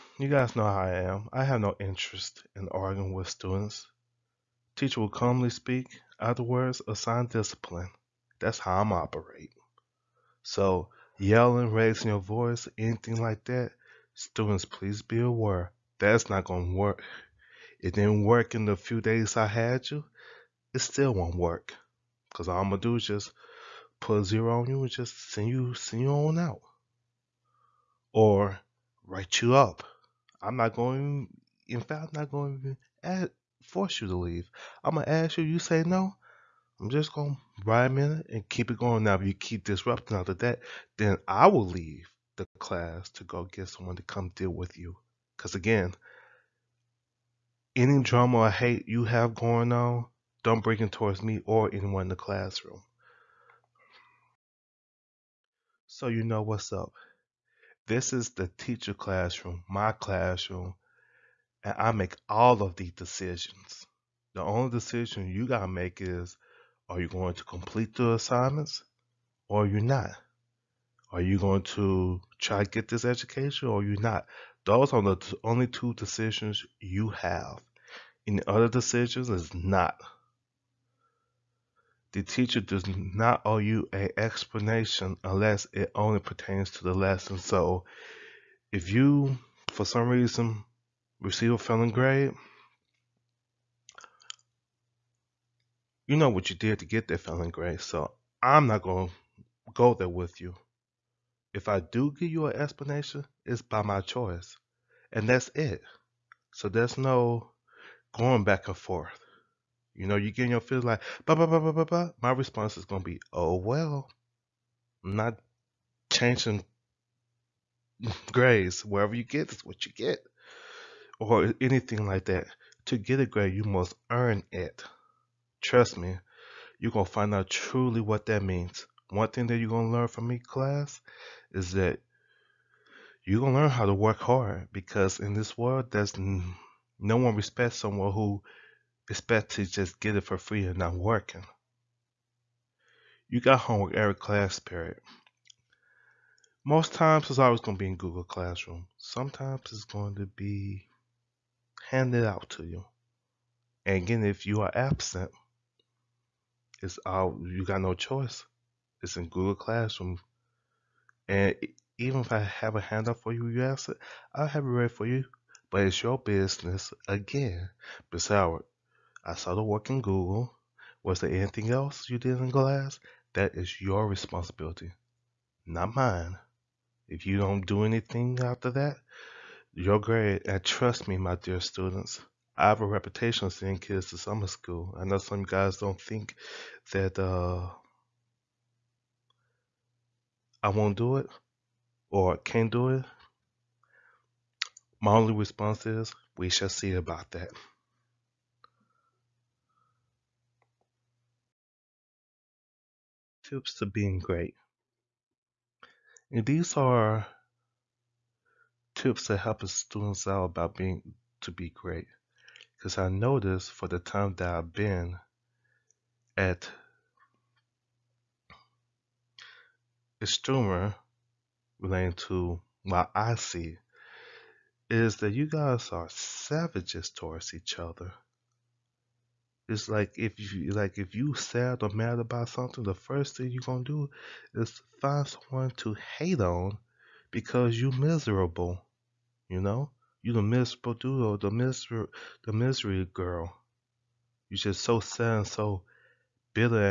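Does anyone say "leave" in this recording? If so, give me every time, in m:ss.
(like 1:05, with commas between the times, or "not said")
0:34, 0:41.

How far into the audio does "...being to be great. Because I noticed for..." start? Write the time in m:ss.
3:30.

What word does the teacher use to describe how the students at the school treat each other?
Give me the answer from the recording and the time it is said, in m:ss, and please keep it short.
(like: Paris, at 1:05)
savages, at 3:46.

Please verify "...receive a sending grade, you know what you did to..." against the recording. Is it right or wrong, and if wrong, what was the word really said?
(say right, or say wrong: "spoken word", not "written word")
wrong: "failing", not "sending".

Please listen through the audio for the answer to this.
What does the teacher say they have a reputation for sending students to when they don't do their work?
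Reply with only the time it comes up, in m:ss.
3:04.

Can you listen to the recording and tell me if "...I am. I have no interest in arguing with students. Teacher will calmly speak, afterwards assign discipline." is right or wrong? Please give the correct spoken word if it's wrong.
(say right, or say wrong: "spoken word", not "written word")
right.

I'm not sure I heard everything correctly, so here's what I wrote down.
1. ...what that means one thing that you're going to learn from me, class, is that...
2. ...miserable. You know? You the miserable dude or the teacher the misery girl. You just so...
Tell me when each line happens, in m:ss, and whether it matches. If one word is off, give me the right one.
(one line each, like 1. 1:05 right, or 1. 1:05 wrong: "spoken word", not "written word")
1. 2:08 right
2. 3:57 wrong: "miser", not "teacher".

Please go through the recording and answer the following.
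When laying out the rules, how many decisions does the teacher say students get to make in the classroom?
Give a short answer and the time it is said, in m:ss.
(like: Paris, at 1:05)
2, at 1:15.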